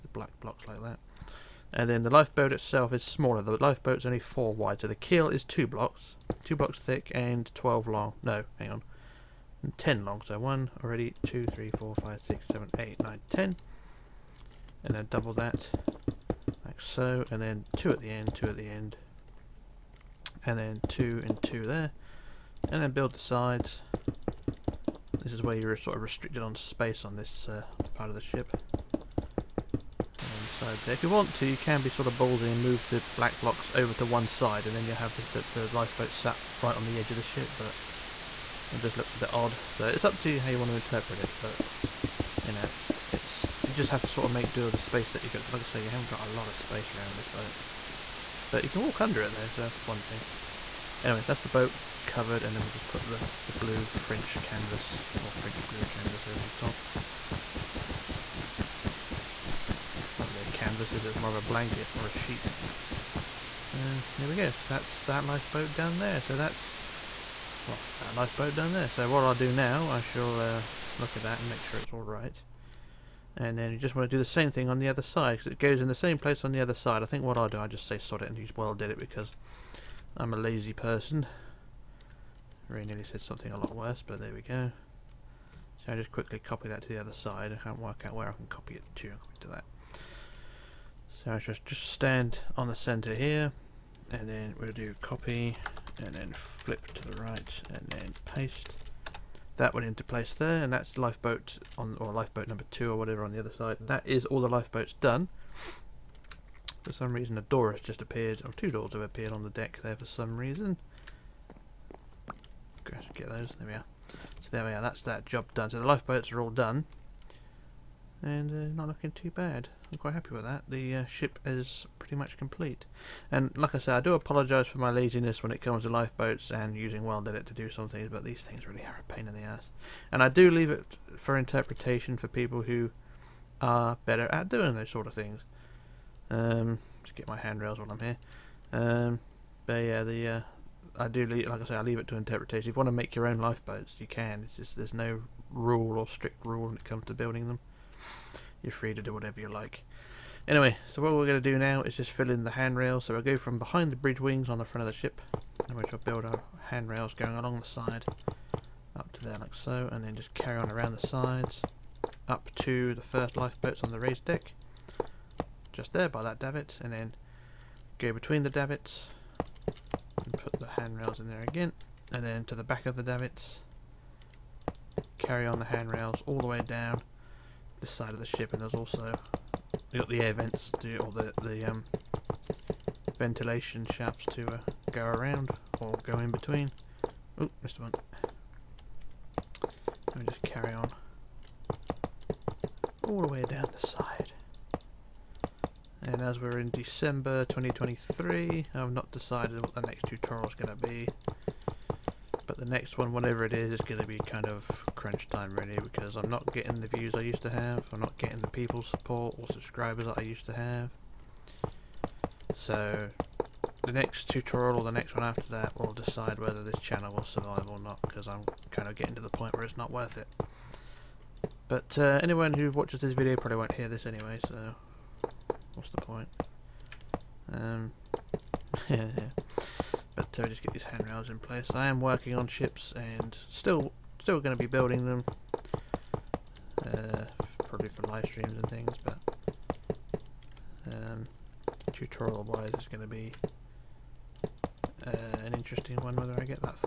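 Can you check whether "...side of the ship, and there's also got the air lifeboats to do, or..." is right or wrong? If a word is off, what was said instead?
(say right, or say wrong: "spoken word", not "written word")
wrong: "vents", not "lifeboats".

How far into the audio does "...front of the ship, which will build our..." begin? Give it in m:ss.
2:34.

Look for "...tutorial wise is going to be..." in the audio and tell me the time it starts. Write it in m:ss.
4:01.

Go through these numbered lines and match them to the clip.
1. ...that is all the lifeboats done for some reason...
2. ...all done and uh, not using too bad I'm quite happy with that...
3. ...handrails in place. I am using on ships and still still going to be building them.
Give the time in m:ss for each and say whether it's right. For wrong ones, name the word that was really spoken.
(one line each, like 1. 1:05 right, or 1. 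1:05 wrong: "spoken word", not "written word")
1. 1:43 right
2. 1:56 wrong: "looking", not "using"
3. 3:50 wrong: "working", not "using".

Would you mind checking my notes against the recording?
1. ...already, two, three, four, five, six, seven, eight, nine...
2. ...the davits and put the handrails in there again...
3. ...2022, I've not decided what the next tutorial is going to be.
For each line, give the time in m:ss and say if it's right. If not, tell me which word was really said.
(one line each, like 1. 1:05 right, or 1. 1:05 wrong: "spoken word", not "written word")
1. 0:10 right
2. 2:48 right
3. 3:17 wrong: "2023", not "2022".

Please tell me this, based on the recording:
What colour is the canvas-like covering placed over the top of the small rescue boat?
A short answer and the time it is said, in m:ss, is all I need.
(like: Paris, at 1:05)
French blue, at 0:55.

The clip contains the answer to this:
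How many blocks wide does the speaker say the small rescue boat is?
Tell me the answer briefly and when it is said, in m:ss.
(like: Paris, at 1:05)
4, at 0:04.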